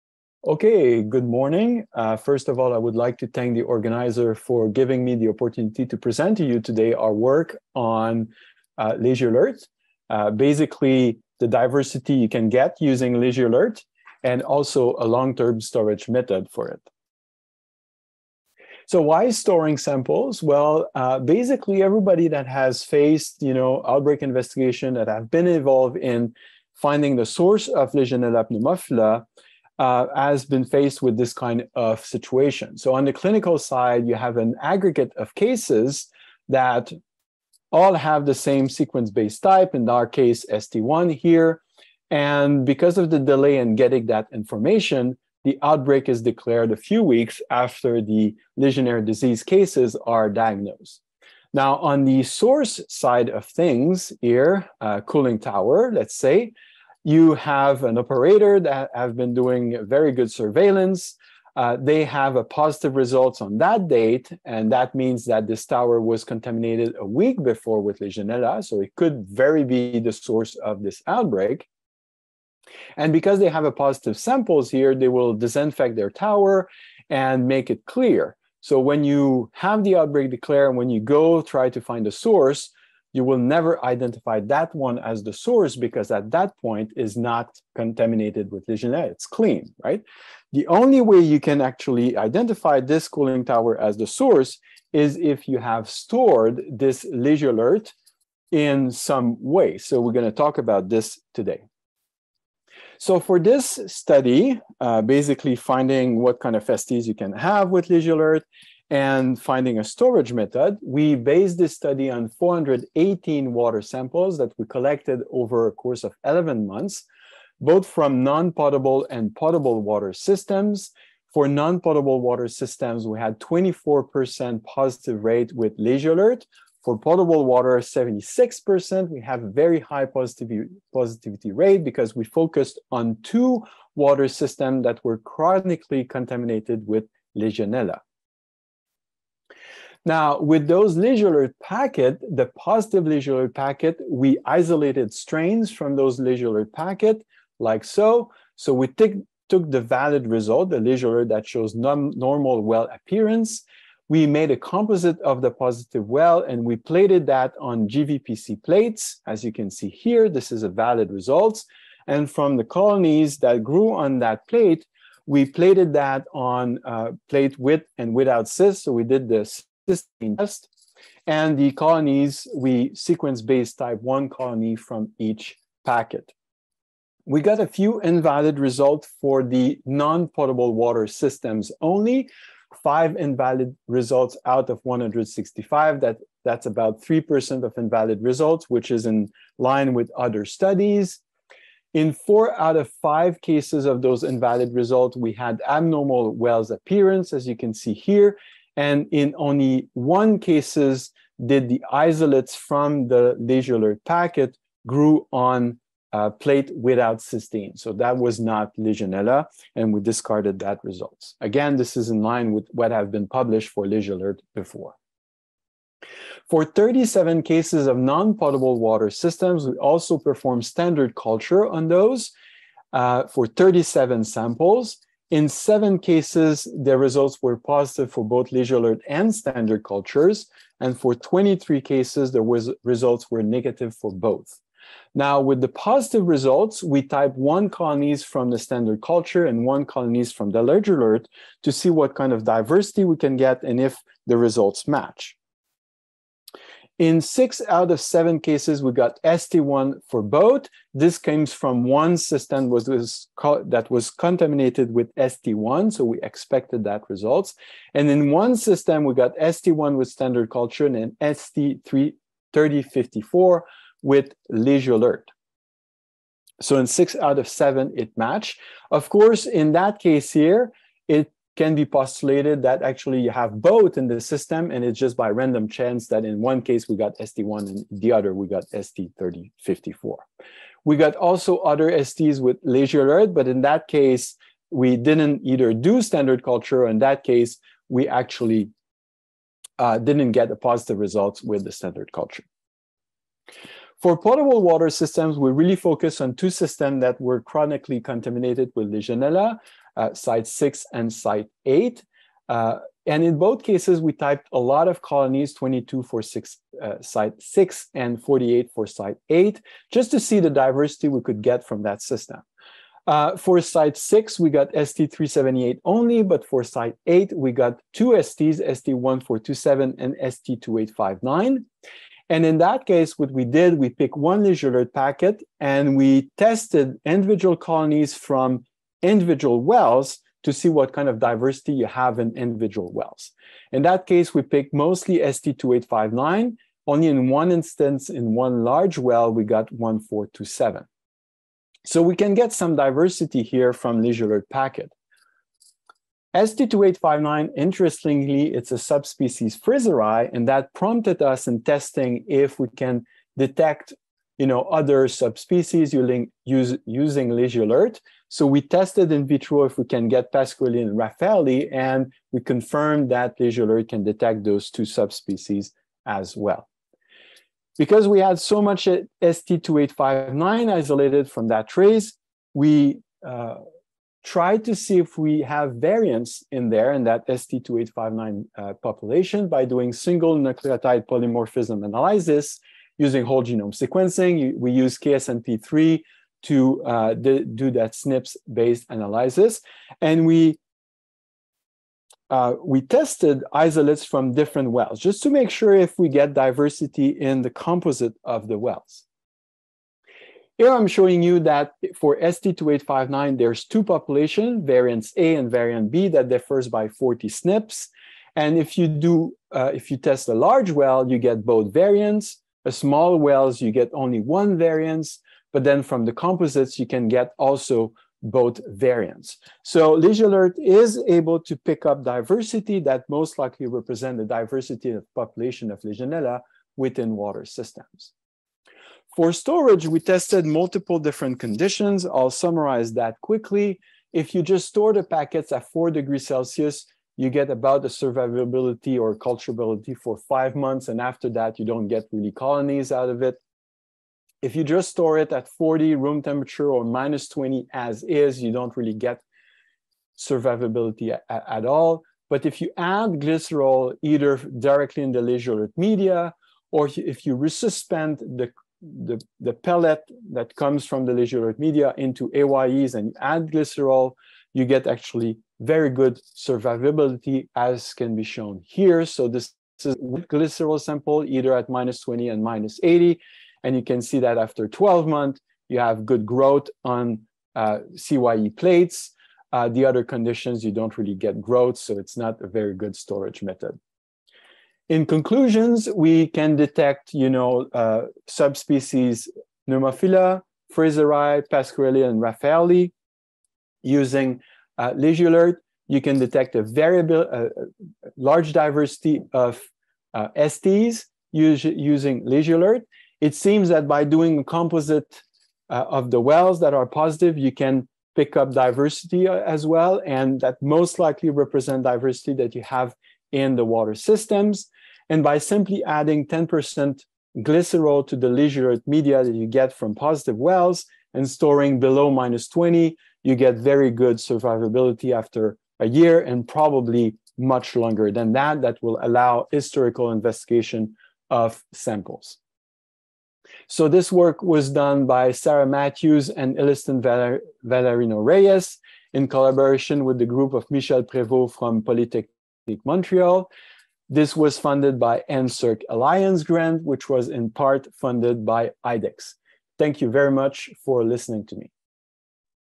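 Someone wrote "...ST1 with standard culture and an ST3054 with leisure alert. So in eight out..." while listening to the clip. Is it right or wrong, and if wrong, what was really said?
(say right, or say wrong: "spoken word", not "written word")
wrong: "six", not "eight".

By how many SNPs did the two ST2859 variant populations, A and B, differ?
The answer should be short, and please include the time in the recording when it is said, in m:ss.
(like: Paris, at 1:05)
40, at 6:46.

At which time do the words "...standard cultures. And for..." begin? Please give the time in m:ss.
3:49.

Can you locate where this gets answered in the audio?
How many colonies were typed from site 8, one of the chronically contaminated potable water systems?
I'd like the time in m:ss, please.
5:08.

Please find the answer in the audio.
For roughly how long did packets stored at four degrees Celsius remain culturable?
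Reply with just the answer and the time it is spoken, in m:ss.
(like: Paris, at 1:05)
5 months, at 7:20.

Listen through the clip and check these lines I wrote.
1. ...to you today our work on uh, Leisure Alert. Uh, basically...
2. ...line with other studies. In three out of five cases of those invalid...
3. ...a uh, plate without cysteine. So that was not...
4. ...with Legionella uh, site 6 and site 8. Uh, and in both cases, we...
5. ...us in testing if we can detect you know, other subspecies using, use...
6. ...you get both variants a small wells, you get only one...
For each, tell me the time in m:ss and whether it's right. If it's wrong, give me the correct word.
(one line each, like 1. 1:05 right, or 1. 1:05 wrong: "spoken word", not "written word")
1. 0:06 right
2. 3:09 wrong: "four", not "three"
3. 3:26 right
4. 4:58 right
5. 5:51 right
6. 6:51 right.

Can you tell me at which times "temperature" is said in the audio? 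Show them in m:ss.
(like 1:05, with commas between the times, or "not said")
7:26.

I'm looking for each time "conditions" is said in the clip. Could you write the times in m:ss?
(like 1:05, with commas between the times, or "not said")
7:11, 8:00.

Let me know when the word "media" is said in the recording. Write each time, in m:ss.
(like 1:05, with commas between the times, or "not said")
7:35, 7:41, 8:38.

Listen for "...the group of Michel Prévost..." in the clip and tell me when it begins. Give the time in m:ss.
9:00.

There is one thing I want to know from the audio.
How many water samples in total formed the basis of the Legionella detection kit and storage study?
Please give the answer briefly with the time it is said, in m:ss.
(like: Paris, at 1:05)
418, at 1:52.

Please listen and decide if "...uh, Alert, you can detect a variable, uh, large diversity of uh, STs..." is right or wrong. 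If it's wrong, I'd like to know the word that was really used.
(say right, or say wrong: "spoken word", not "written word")
right.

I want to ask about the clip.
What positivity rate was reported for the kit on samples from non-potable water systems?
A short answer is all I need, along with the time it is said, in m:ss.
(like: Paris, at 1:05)
24%, at 2:03.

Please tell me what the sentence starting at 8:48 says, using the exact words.
That will allow historical investigation of samples.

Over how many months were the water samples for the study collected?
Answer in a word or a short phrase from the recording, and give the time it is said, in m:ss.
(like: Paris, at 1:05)
11, at 1:56.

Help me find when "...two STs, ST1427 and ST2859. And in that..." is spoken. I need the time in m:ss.
5:17.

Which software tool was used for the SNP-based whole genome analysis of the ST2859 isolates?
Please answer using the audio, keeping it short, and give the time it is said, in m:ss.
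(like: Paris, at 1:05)
KSNP3, at 6:24.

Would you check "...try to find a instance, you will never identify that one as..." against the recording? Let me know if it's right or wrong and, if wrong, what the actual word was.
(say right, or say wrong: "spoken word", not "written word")
wrong: "source", not "instance".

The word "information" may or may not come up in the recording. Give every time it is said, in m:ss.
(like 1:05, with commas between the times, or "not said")
0:44.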